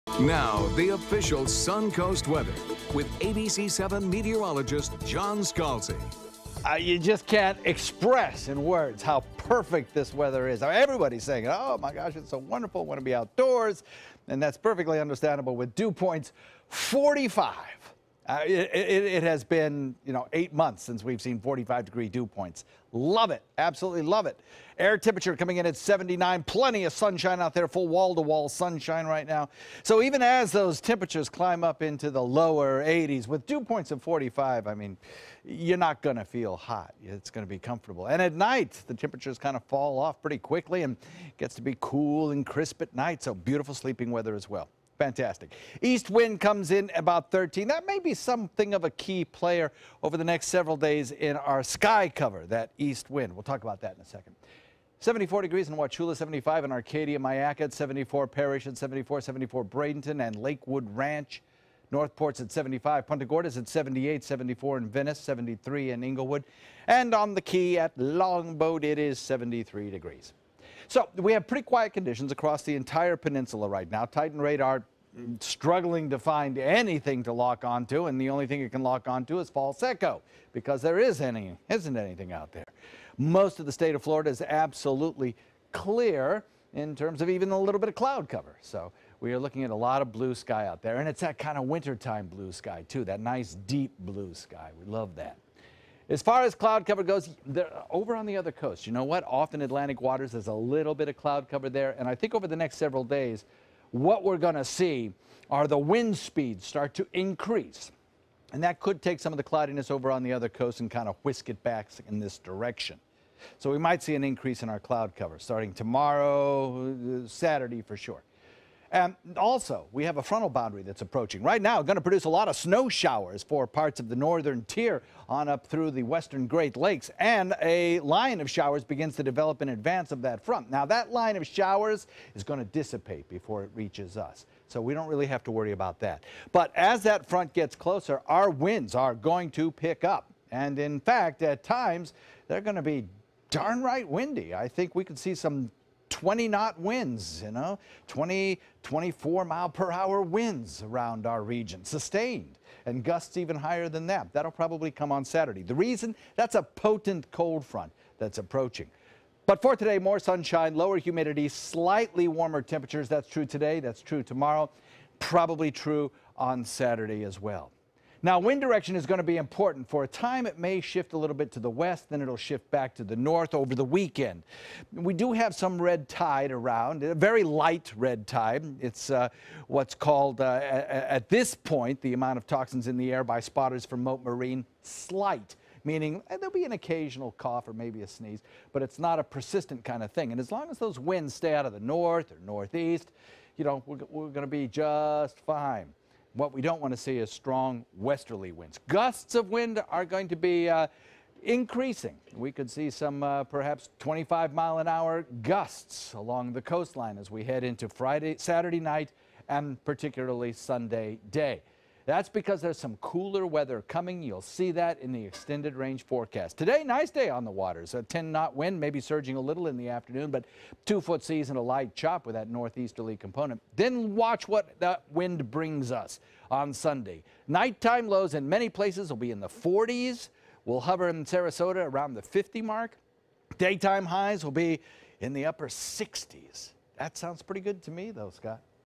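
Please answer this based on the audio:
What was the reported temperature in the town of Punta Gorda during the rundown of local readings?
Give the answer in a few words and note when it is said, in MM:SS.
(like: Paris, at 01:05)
78, at 01:03.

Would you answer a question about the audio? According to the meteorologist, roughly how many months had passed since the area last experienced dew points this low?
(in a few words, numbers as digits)
8.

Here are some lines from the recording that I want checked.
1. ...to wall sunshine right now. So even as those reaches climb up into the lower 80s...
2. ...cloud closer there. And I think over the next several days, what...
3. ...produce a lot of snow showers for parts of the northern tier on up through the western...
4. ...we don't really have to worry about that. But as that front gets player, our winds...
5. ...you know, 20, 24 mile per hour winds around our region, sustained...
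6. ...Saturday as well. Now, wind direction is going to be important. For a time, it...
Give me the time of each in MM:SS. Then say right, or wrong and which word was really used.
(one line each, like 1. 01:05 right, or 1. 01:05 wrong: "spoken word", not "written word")
1. 00:28 wrong: "temperatures", not "reaches"
2. 01:41 wrong: "cover", not "closer"
3. 02:02 right
4. 02:14 wrong: "closer", not "player"
5. 02:27 right
6. 02:46 right.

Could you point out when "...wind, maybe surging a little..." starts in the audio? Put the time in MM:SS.
03:38.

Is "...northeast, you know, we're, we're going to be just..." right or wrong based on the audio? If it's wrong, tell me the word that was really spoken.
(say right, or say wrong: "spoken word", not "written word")
right.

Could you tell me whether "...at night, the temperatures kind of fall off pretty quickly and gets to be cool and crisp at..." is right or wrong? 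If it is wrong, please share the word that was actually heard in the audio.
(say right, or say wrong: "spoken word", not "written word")
right.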